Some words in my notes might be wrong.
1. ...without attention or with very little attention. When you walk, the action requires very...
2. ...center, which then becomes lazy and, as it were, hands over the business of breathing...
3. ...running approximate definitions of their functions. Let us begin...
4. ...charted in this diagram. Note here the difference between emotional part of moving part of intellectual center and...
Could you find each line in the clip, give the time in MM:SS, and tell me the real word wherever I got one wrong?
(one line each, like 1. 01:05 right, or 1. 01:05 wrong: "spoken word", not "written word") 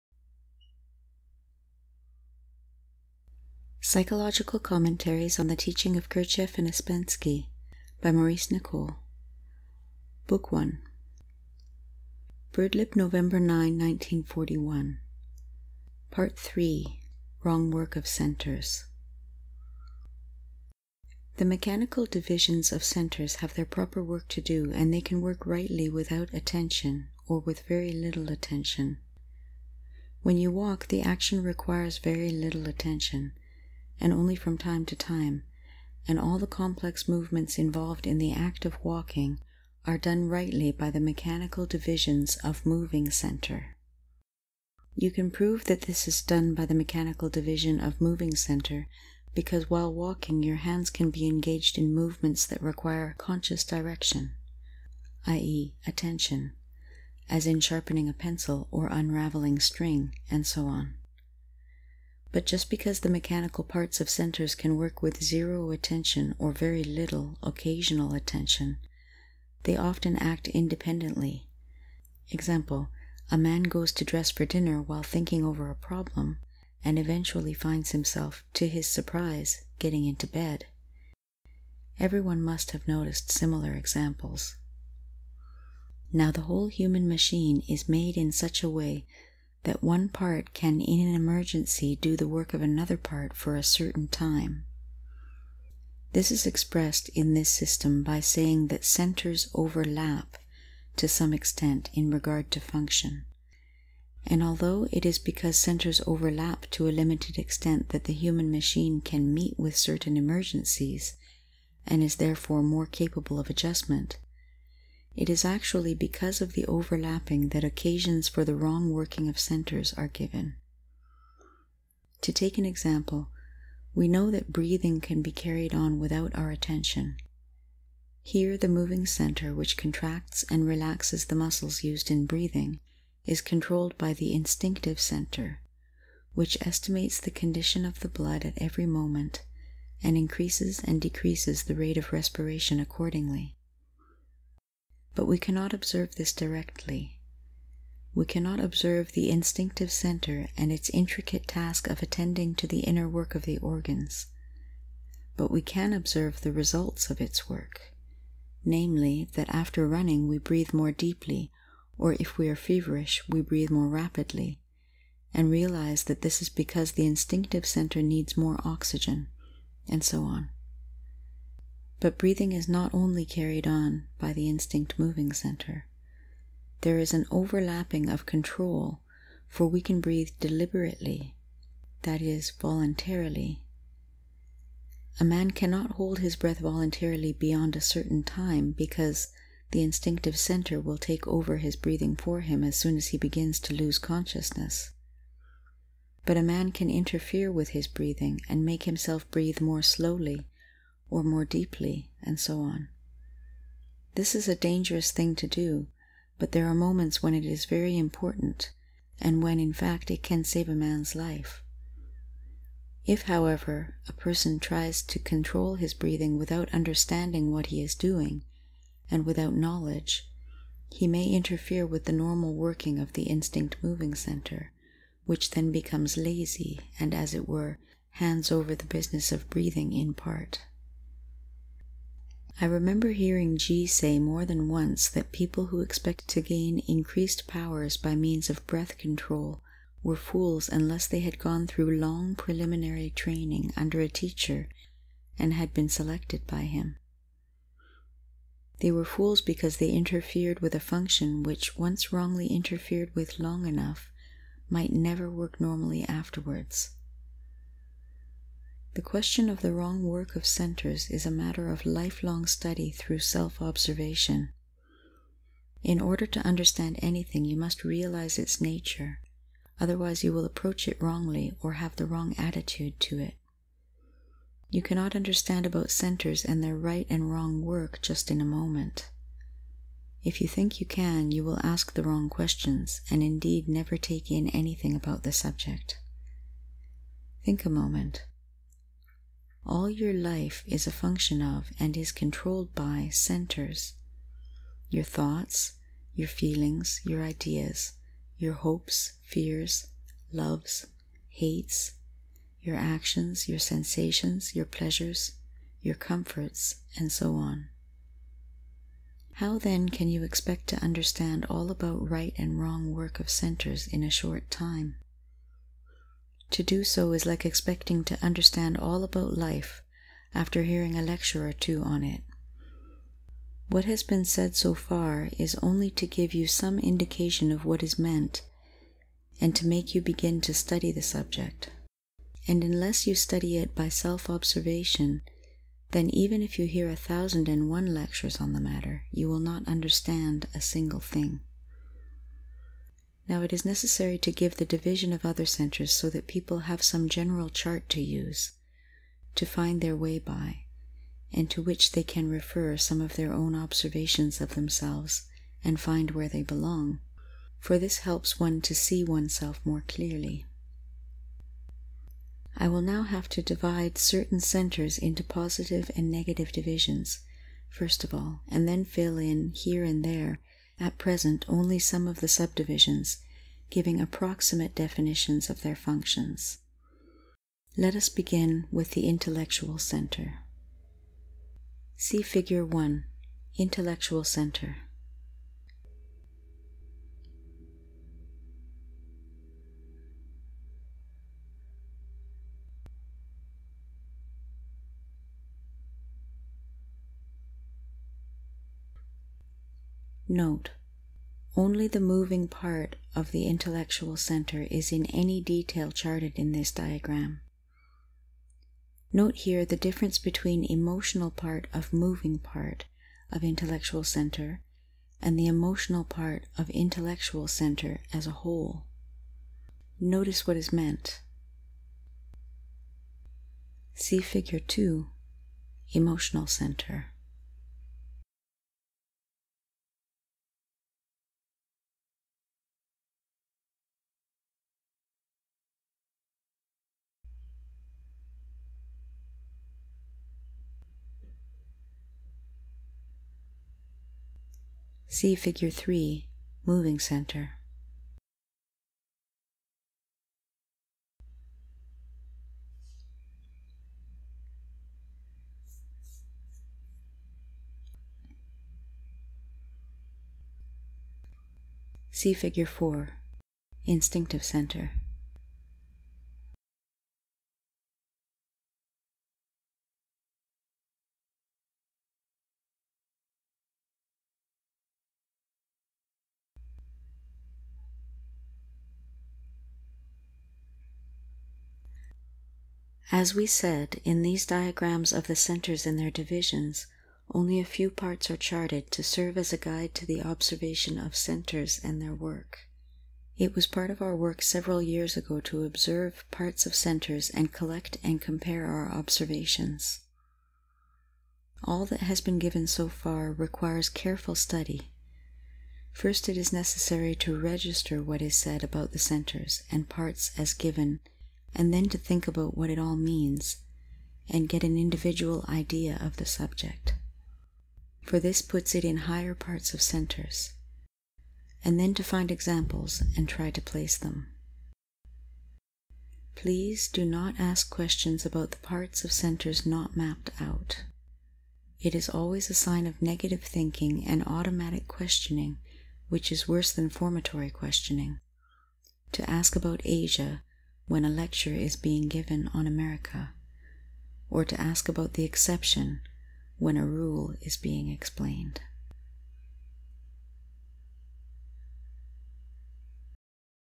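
1. 00:25 right
2. 03:44 right
3. 06:13 wrong: "giving", not "running"
4. 06:45 right.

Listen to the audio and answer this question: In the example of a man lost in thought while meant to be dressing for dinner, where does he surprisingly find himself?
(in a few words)
getting into bed.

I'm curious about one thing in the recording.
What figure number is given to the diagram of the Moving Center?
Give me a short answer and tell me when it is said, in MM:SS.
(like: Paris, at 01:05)
3, at 07:25.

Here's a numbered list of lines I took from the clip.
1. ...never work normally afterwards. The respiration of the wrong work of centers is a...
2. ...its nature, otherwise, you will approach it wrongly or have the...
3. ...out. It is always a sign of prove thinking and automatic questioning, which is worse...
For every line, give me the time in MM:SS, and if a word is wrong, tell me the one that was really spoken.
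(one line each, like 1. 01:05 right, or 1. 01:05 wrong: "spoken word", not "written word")
1. 04:14 wrong: "question", not "respiration"
2. 04:28 right
3. 08:50 wrong: "negative", not "prove".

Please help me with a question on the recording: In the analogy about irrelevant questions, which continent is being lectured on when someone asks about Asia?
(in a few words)
America.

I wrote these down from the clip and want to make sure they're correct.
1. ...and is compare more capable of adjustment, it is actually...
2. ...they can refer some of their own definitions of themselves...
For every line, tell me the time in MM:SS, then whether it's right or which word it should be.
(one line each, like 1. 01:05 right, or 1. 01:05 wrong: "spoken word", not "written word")
1. 01:51 wrong: "therefore", not "compare"
2. 05:51 wrong: "observations", not "definitions".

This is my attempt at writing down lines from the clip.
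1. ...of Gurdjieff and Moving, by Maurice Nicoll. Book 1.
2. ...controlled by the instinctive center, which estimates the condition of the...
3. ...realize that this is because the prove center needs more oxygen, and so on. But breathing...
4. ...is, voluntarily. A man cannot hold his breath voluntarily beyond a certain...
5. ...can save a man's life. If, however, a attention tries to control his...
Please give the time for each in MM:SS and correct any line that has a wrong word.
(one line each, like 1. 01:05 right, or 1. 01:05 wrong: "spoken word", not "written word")
1. 00:05 wrong: "Ouspensky", not "Moving"
2. 02:13 right
3. 02:45 wrong: "instinctive", not "prove"
4. 03:02 right
5. 03:30 wrong: "person", not "attention".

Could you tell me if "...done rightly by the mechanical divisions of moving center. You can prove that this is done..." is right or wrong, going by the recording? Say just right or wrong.
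right.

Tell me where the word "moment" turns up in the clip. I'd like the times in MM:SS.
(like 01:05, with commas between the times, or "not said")
02:18, 03:26, 04:38, 04:47.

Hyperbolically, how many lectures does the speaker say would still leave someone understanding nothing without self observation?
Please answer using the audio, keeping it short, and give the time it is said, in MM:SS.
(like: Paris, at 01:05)
1001, at 05:36.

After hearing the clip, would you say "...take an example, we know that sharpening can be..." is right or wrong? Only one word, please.
wrong.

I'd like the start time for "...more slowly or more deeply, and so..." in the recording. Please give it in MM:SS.
03:19.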